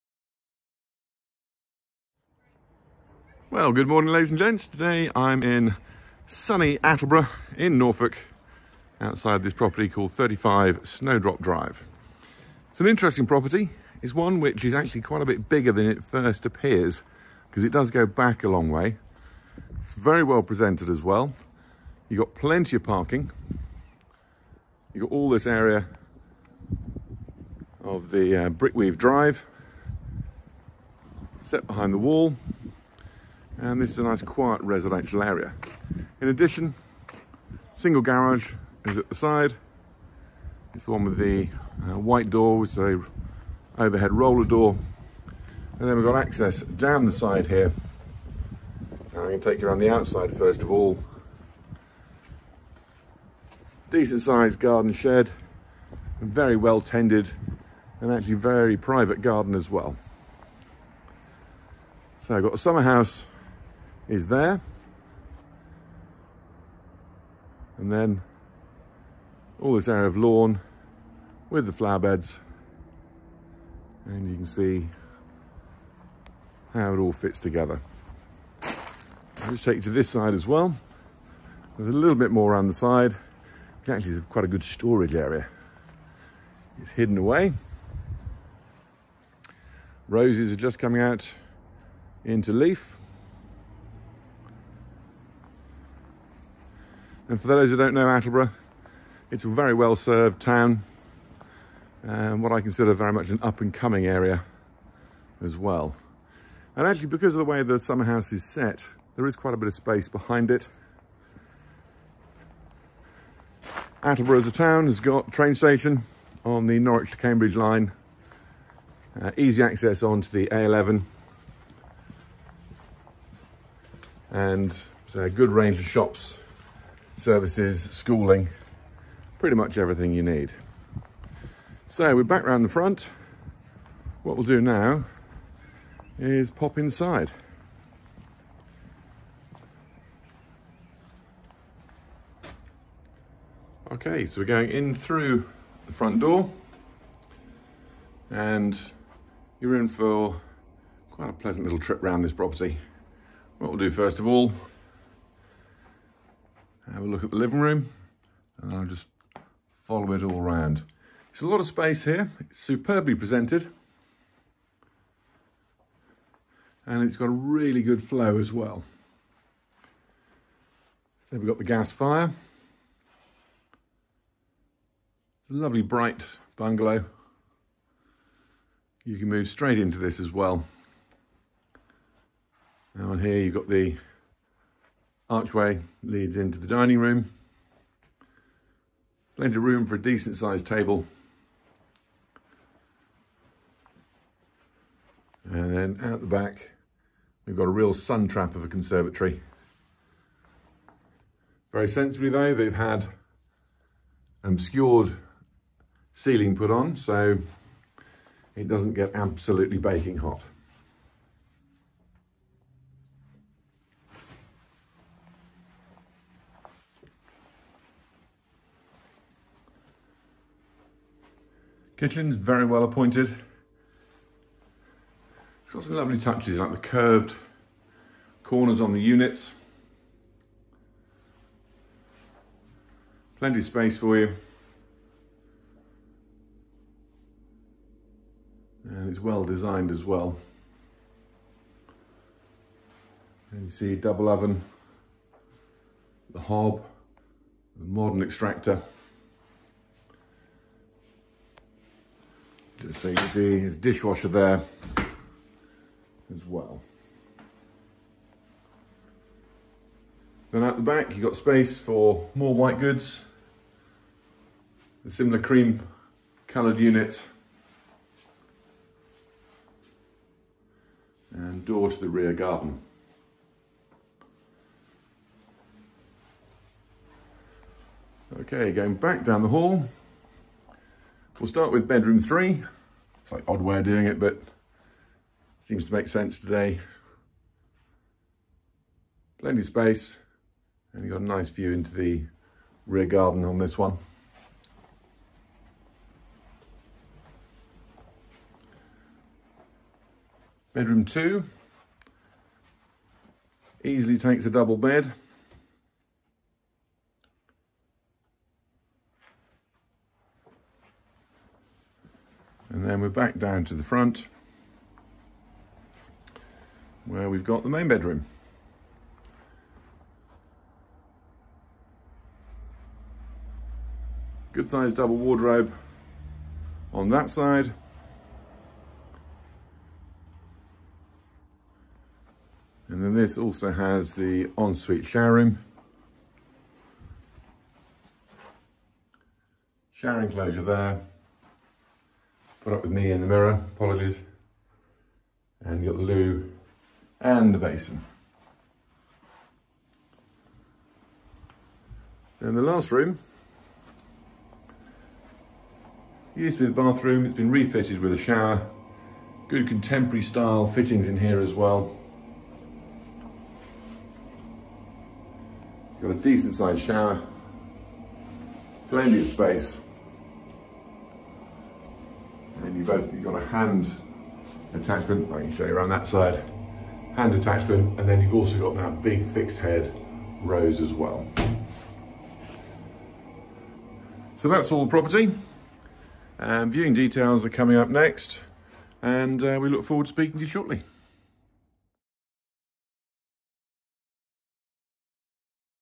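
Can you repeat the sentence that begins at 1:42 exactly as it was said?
and what I consider very much an up and coming area as well.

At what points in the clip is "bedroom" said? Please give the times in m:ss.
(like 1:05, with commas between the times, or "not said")
4:41, 5:00, 5:17.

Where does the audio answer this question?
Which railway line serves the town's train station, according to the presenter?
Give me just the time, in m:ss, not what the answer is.
1:56.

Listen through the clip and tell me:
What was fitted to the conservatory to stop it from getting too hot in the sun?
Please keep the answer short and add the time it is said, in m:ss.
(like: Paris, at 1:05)
An obscured ceiling, at 3:24.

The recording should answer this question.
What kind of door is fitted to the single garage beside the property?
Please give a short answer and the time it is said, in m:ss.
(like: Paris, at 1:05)
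Overhead roller door, at 0:43.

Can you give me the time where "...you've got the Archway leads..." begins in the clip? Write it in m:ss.
3:03.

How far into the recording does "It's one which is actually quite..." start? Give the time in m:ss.
0:14.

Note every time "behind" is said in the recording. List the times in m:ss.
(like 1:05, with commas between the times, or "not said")
0:31, 1:50.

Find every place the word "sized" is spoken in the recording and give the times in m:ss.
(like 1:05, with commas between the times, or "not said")
0:54, 3:10, 5:24, 6:06.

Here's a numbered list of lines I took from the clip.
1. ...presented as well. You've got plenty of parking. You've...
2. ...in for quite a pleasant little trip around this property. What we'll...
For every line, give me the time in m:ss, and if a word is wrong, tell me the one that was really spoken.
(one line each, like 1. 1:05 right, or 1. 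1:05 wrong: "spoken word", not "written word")
1. 0:20 right
2. 2:29 right.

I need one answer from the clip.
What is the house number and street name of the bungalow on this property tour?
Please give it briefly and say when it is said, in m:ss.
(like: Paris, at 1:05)
35 Snowdrop Drive, at 0:10.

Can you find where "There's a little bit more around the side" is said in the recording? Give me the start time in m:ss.
1:21.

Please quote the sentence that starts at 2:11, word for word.
So we're back round the front.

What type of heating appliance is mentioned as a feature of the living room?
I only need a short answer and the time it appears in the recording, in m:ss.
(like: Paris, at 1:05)
Gas fire, at 2:51.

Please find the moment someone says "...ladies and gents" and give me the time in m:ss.
0:04.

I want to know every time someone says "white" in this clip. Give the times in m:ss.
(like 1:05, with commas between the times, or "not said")
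0:41, 4:22.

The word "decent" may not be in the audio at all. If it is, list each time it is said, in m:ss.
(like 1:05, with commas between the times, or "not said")
0:53, 3:10, 6:06.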